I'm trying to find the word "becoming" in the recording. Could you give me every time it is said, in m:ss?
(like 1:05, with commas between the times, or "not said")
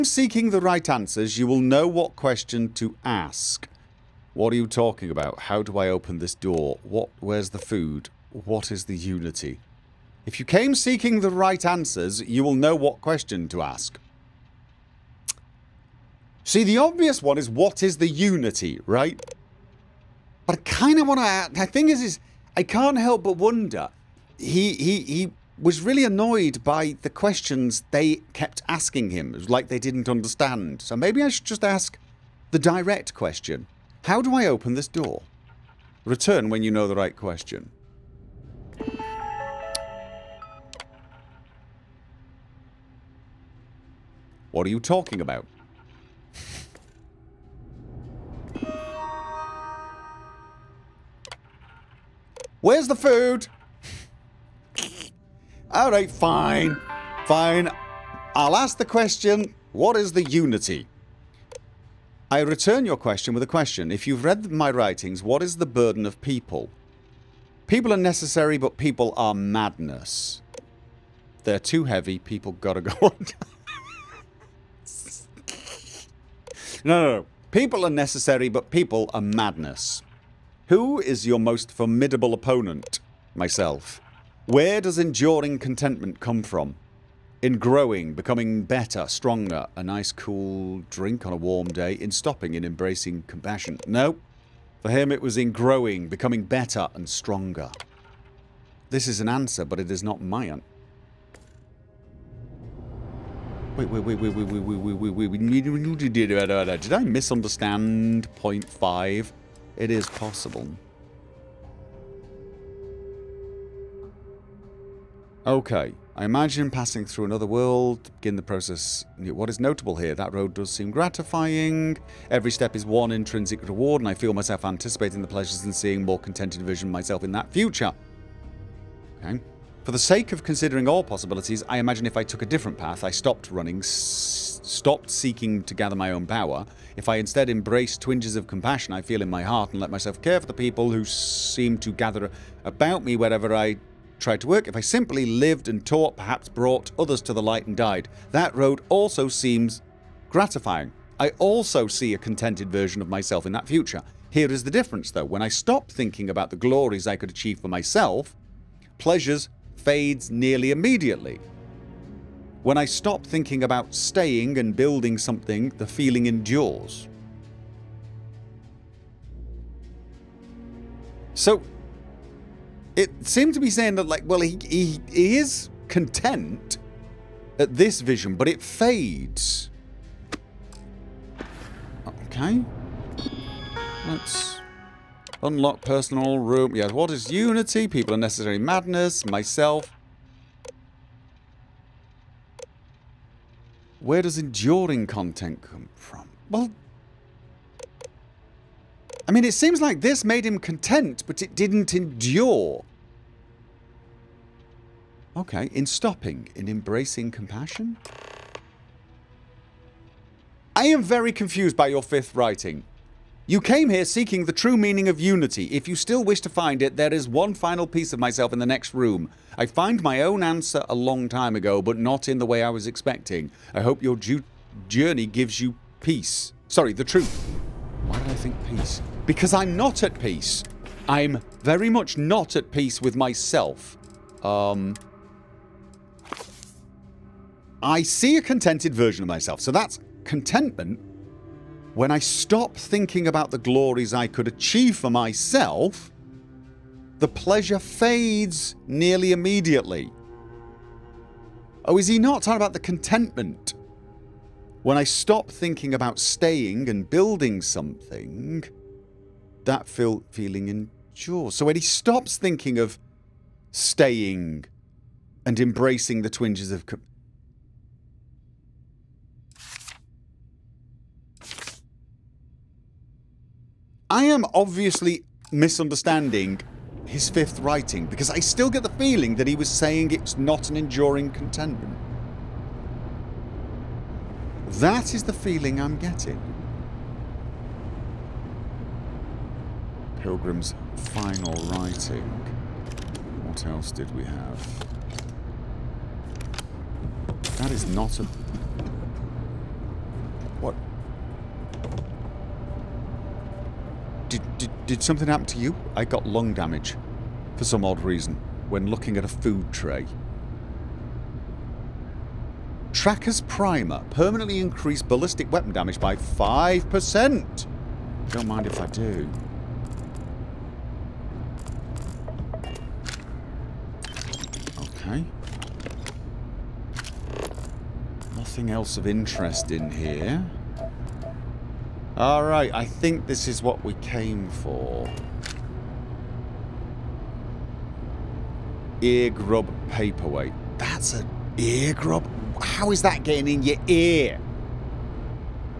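1:28, 1:36.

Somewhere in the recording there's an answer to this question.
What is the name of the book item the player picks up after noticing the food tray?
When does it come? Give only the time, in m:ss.
5:12.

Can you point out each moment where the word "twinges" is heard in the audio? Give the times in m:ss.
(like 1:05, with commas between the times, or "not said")
2:17, 4:26.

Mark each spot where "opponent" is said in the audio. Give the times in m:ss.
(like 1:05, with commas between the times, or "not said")
1:22.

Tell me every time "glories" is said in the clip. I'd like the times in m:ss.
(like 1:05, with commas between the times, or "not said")
2:36, 4:03.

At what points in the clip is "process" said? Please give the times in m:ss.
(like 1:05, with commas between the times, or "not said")
1:58.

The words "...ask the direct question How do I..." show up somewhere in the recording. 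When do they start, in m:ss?
0:31.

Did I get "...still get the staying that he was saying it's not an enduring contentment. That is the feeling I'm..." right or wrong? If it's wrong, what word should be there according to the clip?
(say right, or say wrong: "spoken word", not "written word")
wrong: "feeling", not "staying".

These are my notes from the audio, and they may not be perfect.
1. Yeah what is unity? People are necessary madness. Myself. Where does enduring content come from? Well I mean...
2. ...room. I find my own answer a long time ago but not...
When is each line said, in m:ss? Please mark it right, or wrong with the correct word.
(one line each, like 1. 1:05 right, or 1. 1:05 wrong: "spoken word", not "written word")
1. 3:06 right
2. 3:38 right.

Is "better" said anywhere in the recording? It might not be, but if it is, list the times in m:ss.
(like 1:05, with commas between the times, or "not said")
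1:28, 1:36.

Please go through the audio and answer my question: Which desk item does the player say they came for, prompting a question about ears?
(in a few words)
Ear grub paperweight.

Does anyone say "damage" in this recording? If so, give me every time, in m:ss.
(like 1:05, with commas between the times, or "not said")
5:06, 5:15.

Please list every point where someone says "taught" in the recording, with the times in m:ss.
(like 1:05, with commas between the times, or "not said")
2:25.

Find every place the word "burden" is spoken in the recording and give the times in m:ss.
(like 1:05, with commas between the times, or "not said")
1:05.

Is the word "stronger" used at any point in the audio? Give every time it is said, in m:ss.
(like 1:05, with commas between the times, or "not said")
1:29, 1:37.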